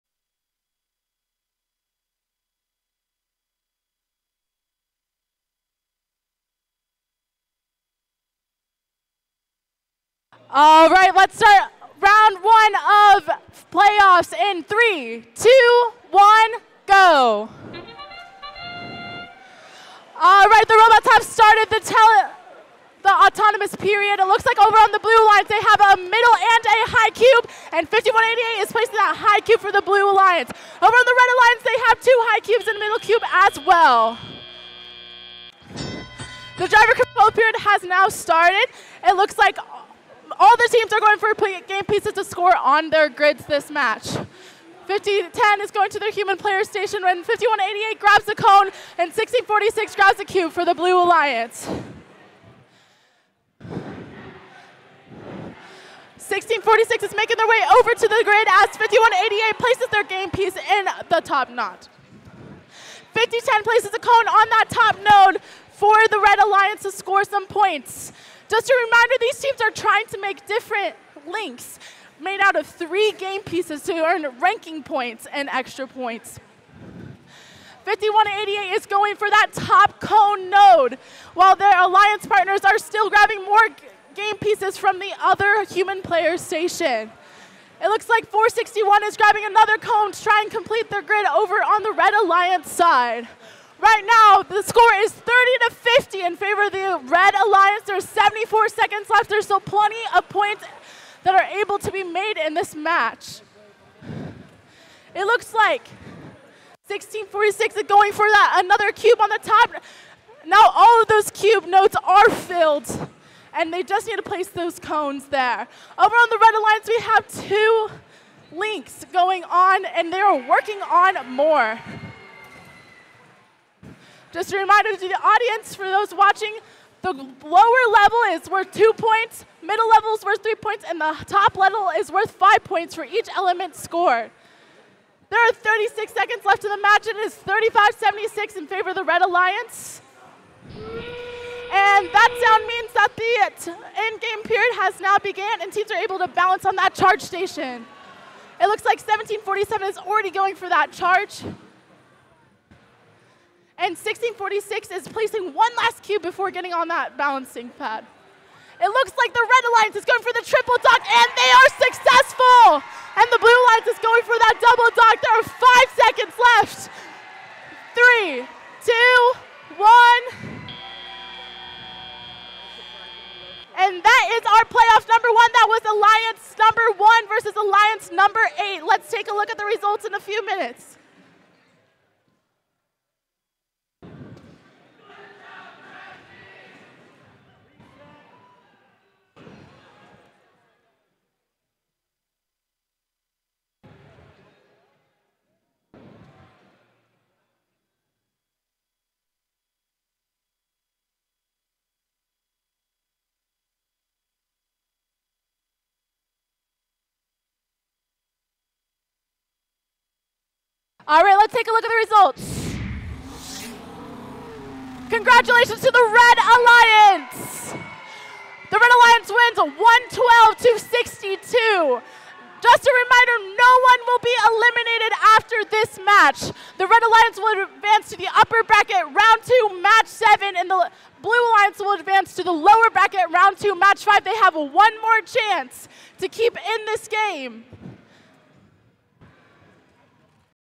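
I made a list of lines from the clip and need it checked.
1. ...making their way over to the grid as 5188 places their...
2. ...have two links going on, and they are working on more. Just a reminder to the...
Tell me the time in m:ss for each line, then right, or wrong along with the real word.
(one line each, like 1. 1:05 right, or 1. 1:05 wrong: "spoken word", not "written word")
1. 0:57 right
2. 1:57 right.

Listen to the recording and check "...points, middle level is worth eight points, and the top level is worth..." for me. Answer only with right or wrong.
wrong.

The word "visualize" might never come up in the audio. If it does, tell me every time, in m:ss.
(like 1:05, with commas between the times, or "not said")
not said.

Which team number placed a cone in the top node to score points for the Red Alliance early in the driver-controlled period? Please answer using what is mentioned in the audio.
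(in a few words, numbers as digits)
5010.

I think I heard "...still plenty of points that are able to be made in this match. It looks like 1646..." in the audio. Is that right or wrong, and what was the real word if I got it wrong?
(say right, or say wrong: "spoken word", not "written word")
right.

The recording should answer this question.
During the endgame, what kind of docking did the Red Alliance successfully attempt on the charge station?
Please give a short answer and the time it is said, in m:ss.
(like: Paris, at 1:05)
Triple dock, at 2:40.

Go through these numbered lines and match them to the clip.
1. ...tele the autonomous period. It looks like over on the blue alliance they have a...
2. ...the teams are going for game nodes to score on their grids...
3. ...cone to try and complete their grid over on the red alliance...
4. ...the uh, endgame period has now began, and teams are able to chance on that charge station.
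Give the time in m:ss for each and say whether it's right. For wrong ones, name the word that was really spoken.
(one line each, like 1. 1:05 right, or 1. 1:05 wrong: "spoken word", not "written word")
1. 0:21 right
2. 0:40 wrong: "pieces", not "nodes"
3. 1:29 right
4. 2:23 wrong: "balance", not "chance".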